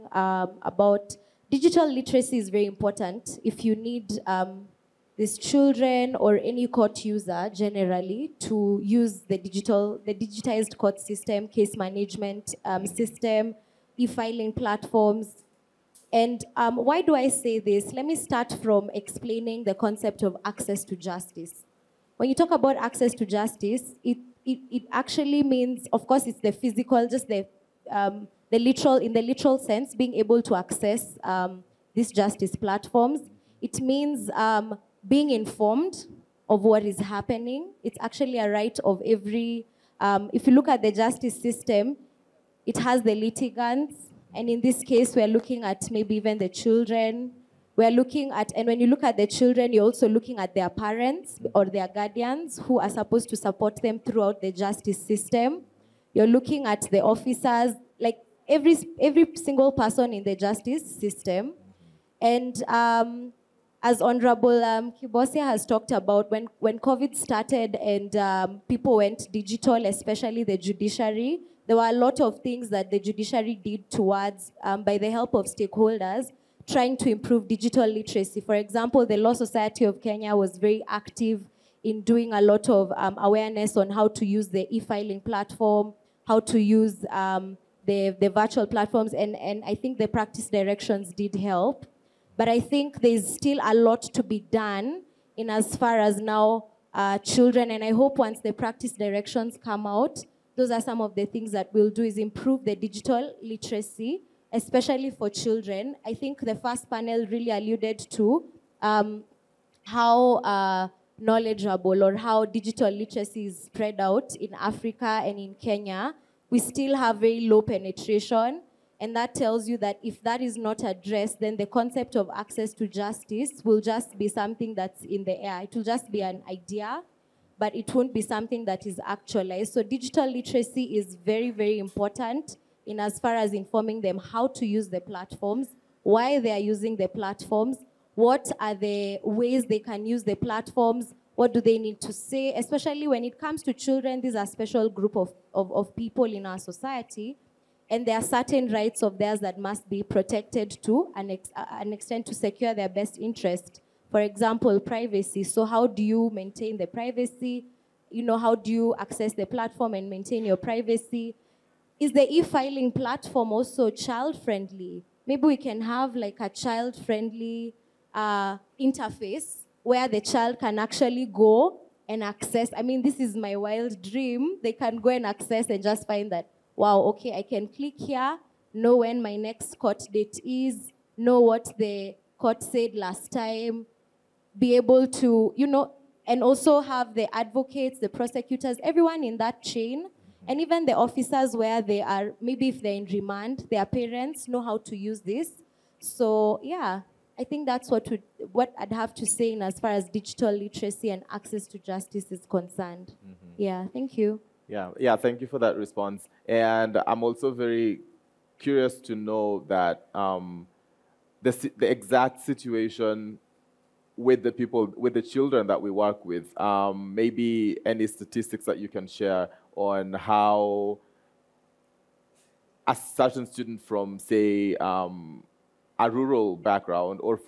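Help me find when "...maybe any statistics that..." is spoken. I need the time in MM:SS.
03:37.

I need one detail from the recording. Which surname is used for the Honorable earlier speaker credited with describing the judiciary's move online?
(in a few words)
Kibosia.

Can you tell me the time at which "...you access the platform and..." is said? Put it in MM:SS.
02:38.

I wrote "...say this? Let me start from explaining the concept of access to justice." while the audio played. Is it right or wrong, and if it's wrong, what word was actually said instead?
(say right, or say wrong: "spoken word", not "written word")
right.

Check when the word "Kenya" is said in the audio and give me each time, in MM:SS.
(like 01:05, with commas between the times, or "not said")
01:20, 01:55.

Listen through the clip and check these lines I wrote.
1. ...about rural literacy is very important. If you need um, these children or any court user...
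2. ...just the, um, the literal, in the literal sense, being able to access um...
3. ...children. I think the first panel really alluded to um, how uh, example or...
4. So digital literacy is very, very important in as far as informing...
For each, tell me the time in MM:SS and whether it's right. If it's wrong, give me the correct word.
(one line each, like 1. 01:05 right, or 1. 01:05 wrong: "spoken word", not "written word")
1. 00:00 wrong: "digital", not "rural"
2. 00:27 right
3. 01:45 wrong: "knowledgeable", not "example"
4. 02:09 right.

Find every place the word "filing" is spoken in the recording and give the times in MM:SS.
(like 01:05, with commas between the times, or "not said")
00:13, 01:24, 02:42.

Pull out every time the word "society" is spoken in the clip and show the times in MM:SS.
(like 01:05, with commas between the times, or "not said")
01:19, 02:26.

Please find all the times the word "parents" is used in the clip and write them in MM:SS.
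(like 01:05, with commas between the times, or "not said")
00:50, 03:13.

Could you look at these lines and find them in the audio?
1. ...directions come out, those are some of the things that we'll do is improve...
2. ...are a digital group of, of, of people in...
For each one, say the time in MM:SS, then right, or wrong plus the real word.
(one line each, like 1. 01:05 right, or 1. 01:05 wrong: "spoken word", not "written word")
1. 01:38 right
2. 02:24 wrong: "special", not "digital".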